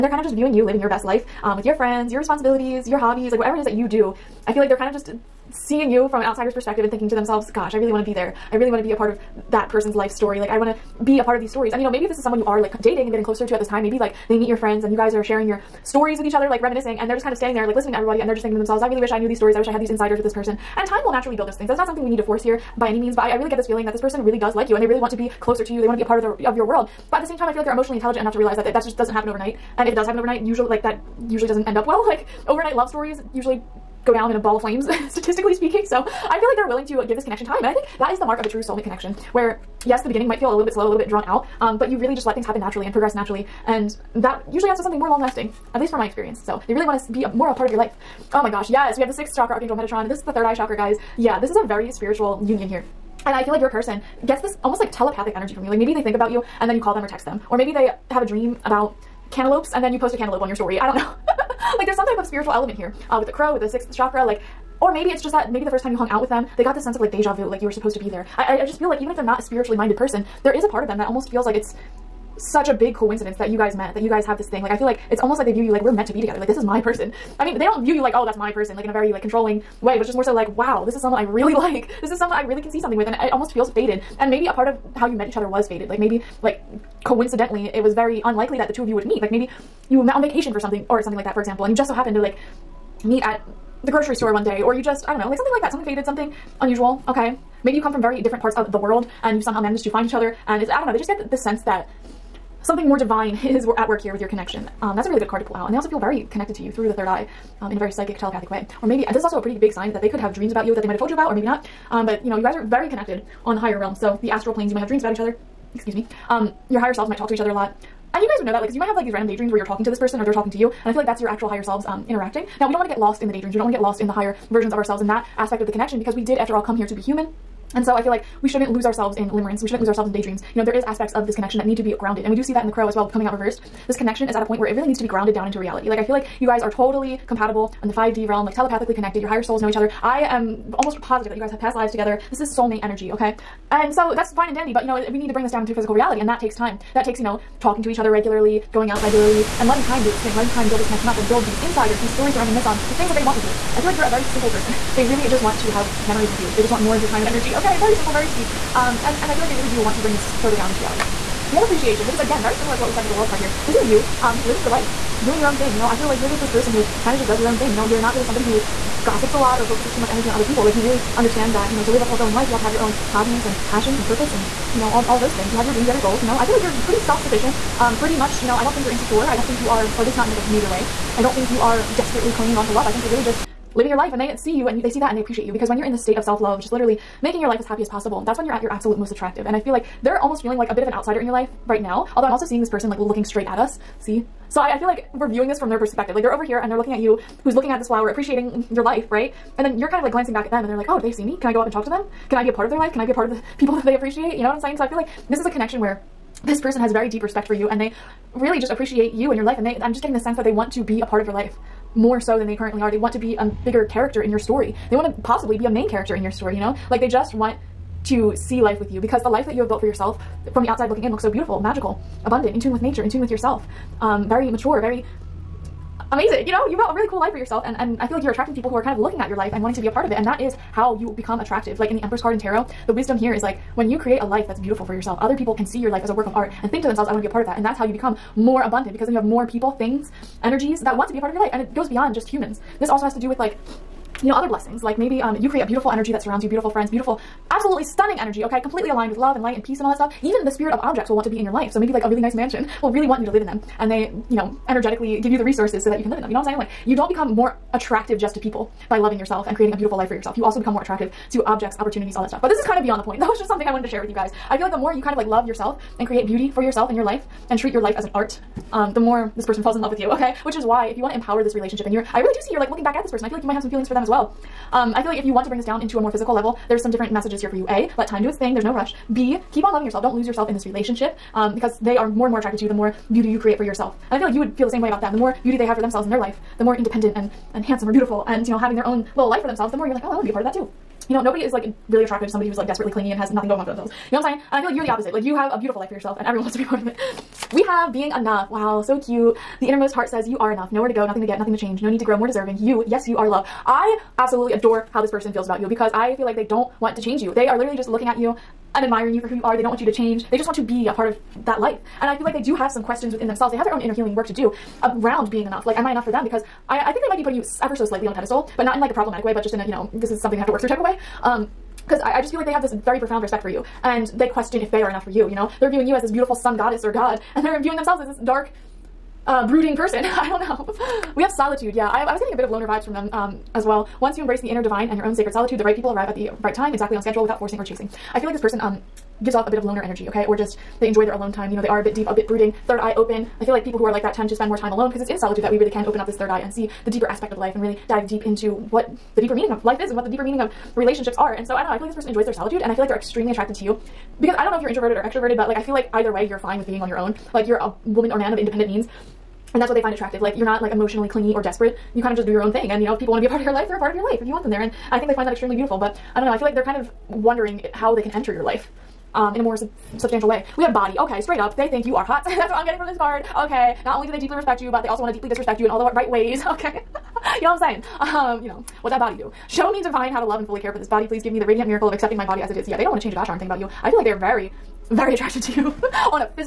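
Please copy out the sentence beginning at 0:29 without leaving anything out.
And if it does happen overnight, usually, like, that usually doesn't end up well.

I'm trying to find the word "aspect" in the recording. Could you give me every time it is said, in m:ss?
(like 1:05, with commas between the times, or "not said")
2:05, 2:10, 5:47.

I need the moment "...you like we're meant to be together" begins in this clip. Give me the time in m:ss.
1:15.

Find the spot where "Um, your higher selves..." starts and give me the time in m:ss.
1:56.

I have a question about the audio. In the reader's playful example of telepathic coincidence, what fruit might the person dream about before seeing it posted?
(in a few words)
Cantaloupe.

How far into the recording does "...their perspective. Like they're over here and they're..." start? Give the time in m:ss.
3:15.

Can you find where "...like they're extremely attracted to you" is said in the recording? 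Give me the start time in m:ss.
5:52.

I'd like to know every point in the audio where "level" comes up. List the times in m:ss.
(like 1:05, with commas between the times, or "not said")
4:36.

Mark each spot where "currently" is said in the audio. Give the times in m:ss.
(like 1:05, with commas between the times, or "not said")
3:32.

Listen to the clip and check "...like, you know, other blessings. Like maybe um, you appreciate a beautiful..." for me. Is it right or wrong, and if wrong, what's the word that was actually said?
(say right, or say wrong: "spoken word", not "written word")
wrong: "create", not "appreciate".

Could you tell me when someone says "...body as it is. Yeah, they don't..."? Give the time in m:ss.
6:22.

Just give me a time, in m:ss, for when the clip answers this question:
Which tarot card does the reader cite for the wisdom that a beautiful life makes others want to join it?
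3:52.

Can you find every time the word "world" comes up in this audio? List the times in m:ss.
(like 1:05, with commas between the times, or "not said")
0:26, 1:38, 2:43.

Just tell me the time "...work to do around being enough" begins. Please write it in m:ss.
5:14.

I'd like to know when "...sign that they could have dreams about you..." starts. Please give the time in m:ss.
1:49.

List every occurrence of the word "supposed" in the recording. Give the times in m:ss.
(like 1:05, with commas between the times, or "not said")
1:07.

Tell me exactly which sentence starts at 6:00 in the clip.
Like you're not like emotionally clingy or desperate you kind of just do your own thing.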